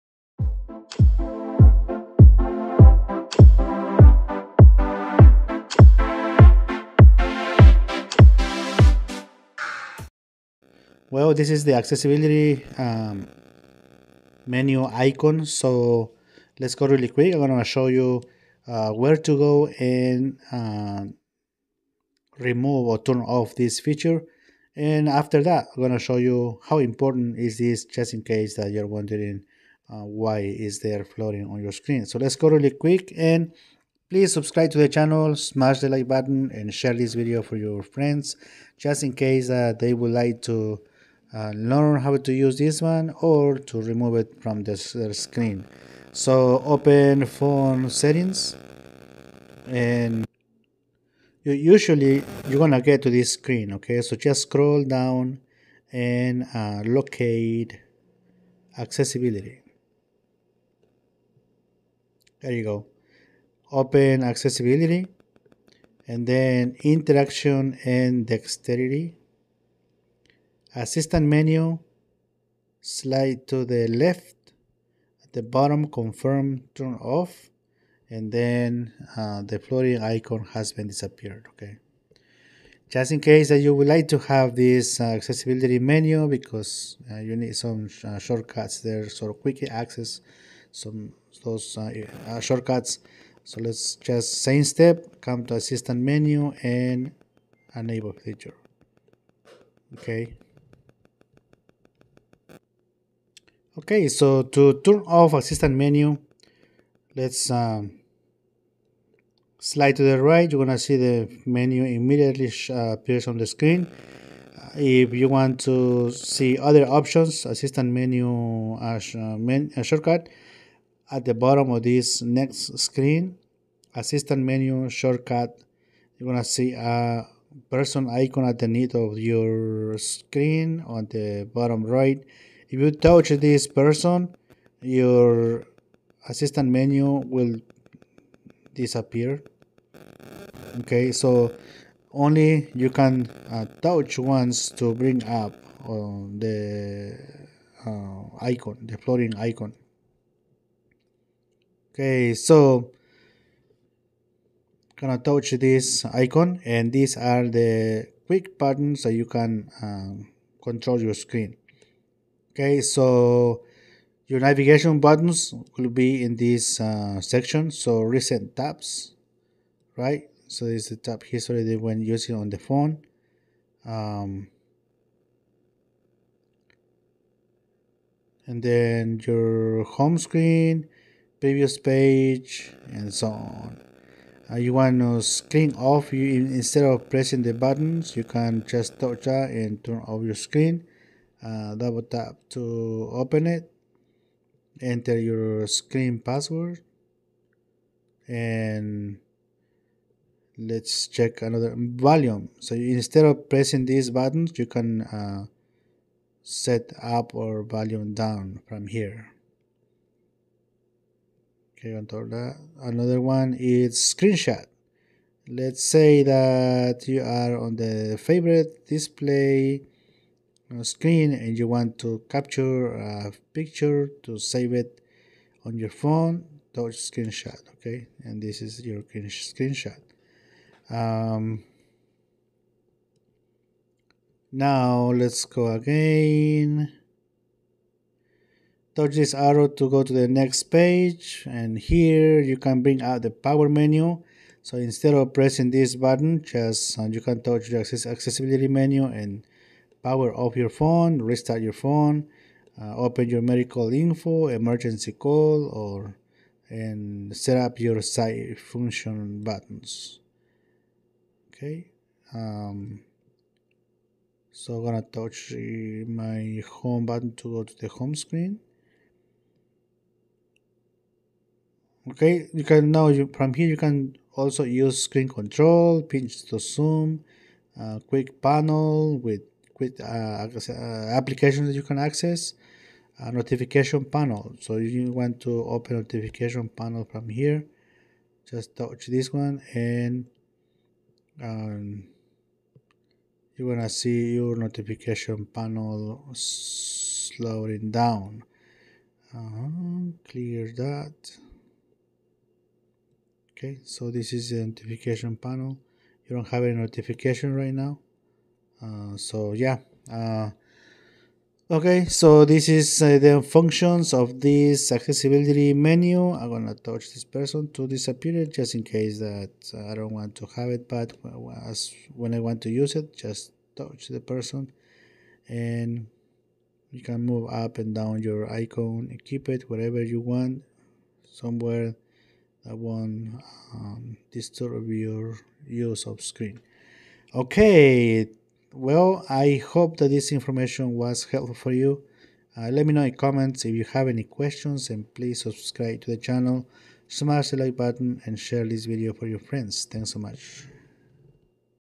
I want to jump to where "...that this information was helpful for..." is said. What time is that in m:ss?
5:39.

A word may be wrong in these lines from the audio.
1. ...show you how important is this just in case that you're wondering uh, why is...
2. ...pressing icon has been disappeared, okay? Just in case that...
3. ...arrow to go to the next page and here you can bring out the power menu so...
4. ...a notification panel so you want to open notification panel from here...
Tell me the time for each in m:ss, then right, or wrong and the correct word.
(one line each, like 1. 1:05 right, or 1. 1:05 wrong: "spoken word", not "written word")
1. 0:25 right
2. 1:19 wrong: "floating", not "pressing"
3. 3:59 right
4. 4:43 right.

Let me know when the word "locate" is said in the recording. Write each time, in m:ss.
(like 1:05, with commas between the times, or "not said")
0:56.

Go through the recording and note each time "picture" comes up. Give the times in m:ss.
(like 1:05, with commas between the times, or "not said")
3:43.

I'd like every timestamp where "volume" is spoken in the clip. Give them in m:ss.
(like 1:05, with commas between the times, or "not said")
3:21, 3:27.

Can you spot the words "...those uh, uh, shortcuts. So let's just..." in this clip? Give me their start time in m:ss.
1:31.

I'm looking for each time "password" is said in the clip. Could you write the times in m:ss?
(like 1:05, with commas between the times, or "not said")
3:16.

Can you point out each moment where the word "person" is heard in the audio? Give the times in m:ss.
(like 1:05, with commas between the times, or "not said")
2:07, 2:13, 5:17, 5:24.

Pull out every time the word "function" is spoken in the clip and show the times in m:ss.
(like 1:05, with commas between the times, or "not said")
4:18, 5:13.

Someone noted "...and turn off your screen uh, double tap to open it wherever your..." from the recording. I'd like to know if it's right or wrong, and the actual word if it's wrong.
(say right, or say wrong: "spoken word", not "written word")
wrong: "enter", not "wherever".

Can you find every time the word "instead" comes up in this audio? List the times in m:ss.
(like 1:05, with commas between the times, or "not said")
3:06, 3:22, 4:04.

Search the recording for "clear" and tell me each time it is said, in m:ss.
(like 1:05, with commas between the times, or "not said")
5:00.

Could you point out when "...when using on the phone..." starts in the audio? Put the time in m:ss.
2:51.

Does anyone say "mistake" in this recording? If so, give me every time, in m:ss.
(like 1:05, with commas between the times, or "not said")
not said.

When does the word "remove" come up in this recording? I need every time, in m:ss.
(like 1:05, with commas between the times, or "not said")
0:22, 0:43.